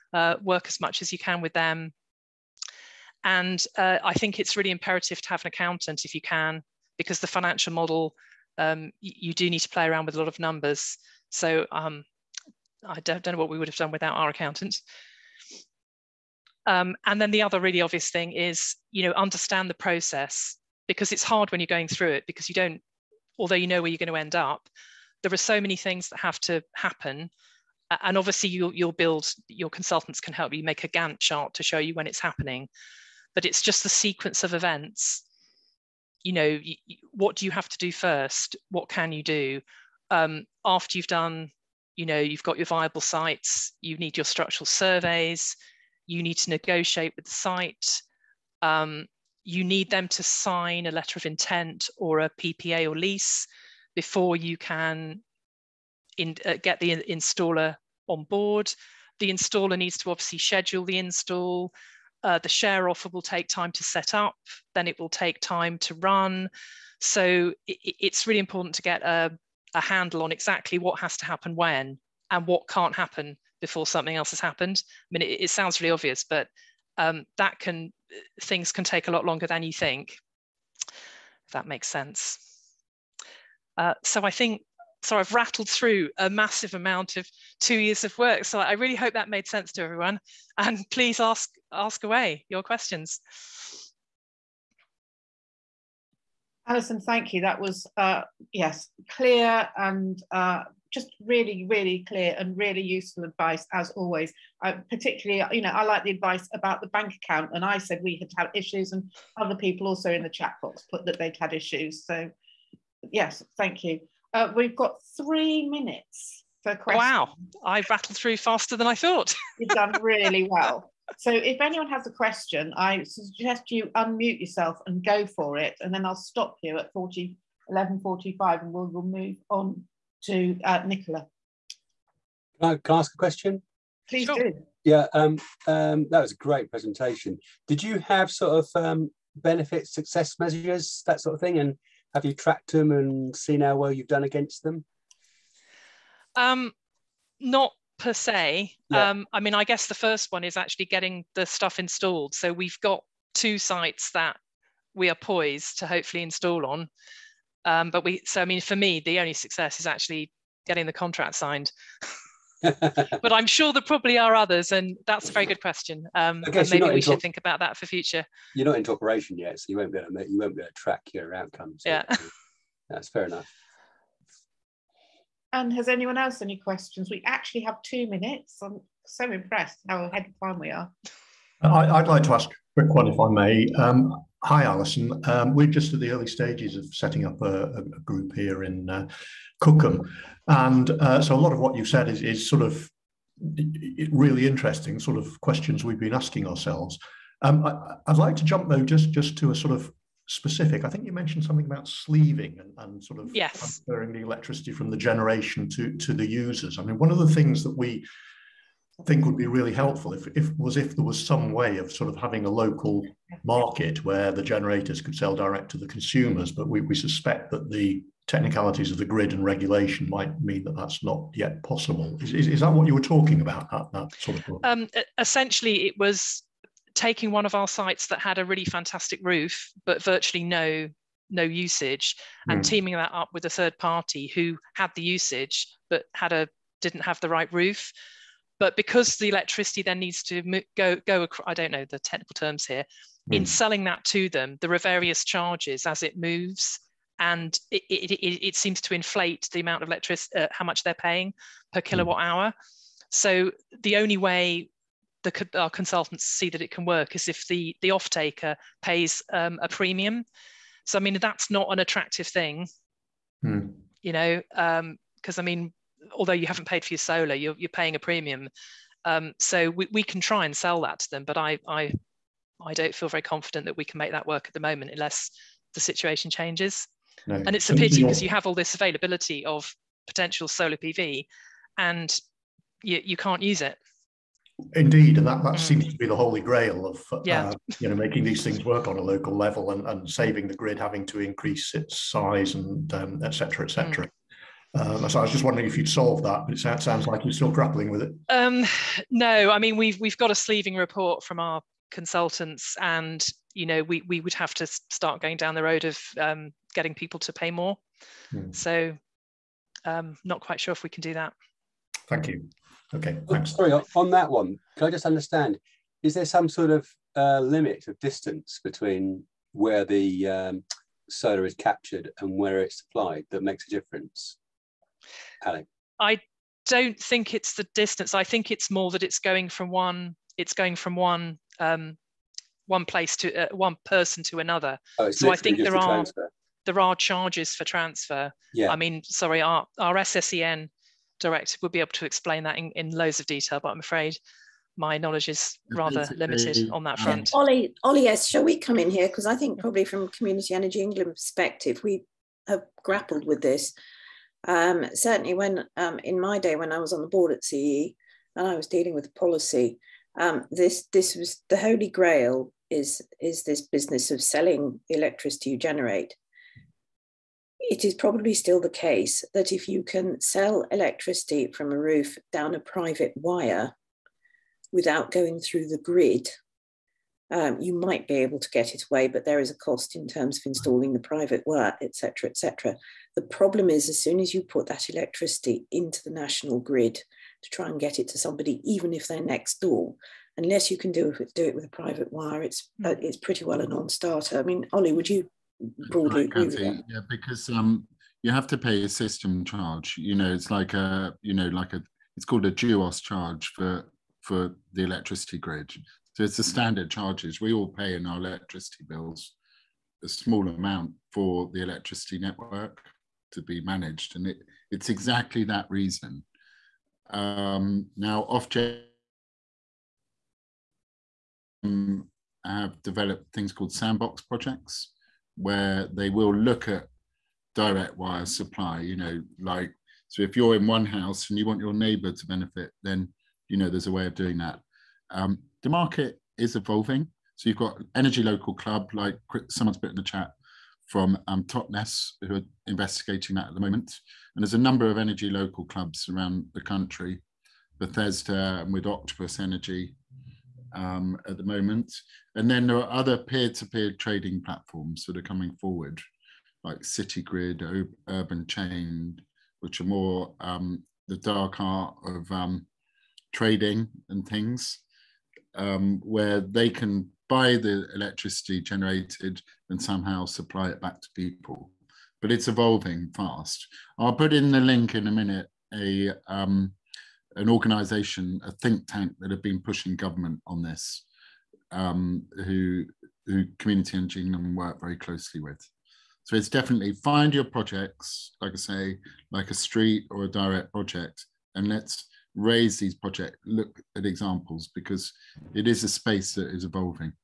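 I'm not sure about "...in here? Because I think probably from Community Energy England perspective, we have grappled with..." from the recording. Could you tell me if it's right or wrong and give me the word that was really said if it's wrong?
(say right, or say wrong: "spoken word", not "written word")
right.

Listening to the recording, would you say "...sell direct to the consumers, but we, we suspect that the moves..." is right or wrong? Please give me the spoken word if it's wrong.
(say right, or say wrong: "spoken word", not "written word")
wrong: "technicalities", not "moves".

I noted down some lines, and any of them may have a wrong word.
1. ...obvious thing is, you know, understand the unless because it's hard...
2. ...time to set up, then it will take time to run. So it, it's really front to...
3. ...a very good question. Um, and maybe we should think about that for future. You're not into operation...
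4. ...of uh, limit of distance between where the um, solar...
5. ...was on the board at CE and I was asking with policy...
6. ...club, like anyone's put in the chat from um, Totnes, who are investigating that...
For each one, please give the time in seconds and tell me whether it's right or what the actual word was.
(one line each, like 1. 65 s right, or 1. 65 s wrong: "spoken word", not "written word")
1. 17 s wrong: "process", not "unless"
2. 63 s wrong: "important", not "front"
3. 165 s right
4. 316 s right
5. 356 s wrong: "dealing", not "asking"
6. 438 s wrong: "someone", not "anyone".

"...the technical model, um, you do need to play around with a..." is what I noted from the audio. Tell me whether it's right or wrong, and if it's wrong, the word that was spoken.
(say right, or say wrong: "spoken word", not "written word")
wrong: "financial", not "technical".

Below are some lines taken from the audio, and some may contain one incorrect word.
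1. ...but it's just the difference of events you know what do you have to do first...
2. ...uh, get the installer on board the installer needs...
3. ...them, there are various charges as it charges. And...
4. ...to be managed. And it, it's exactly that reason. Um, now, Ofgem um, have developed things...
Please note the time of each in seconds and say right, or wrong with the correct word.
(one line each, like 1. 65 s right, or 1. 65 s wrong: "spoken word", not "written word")
1. 33 s wrong: "sequence", not "difference"
2. 56 s right
3. 244 s wrong: "moves", not "charges"
4. 413 s right.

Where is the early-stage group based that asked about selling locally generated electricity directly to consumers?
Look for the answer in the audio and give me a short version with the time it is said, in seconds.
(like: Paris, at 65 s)
Cookham, at 189 s.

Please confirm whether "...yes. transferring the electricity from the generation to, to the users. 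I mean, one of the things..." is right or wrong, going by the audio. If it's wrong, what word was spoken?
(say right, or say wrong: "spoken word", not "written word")
right.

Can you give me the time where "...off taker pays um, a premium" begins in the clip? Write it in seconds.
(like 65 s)
257 s.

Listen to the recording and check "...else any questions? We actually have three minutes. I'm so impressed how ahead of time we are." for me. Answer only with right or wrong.
wrong.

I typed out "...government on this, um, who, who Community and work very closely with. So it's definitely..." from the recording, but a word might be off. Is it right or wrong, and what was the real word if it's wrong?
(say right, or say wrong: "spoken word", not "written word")
right.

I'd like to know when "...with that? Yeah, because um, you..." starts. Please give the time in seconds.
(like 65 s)
396 s.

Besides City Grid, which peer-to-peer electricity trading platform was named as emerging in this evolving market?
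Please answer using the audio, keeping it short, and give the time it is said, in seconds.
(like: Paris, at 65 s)
Urban Chain, at 458 s.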